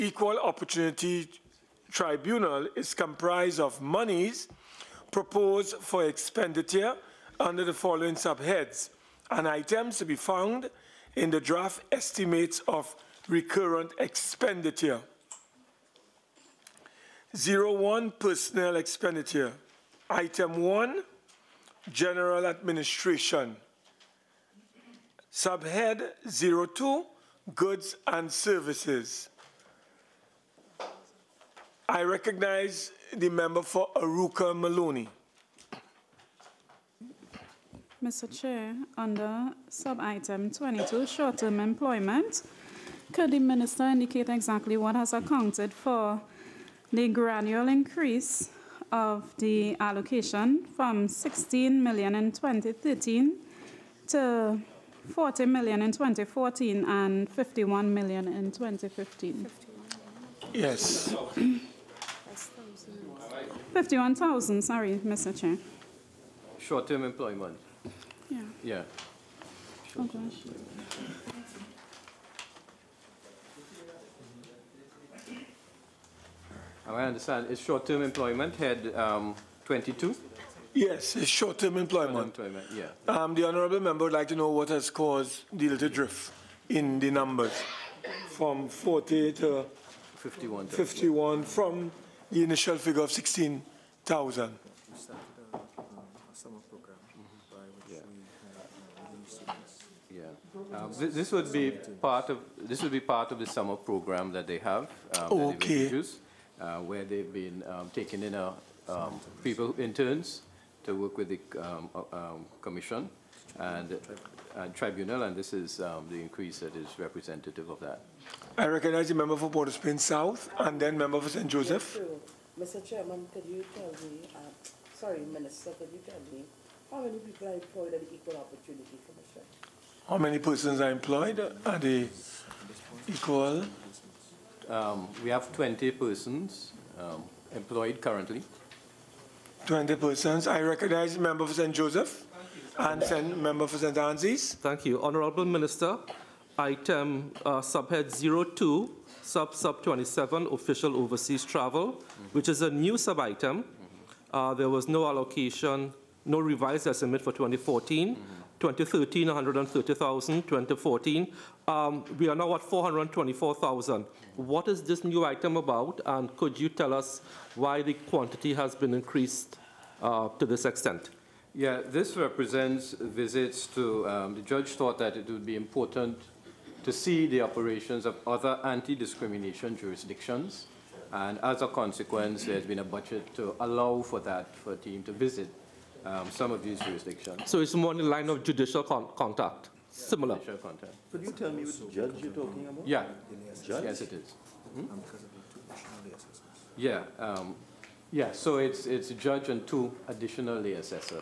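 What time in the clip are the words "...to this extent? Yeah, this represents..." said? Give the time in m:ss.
2:50.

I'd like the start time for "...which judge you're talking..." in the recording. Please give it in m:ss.
3:11.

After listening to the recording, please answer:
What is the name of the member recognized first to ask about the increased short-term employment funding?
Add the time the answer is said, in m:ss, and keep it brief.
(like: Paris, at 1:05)
Arouca, at 0:33.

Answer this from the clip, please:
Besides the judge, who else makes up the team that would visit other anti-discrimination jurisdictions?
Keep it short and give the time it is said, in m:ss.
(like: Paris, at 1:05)
two additional assessors, at 3:19.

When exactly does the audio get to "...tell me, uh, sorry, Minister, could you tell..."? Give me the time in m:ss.
2:03.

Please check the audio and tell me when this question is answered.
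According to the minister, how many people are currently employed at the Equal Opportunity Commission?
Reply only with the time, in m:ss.
2:15.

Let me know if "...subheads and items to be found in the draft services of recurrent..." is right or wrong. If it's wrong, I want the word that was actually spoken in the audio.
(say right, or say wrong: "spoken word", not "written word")
wrong: "estimates", not "services".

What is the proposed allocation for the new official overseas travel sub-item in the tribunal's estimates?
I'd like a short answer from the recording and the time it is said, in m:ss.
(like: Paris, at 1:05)
424,000, at 2:42.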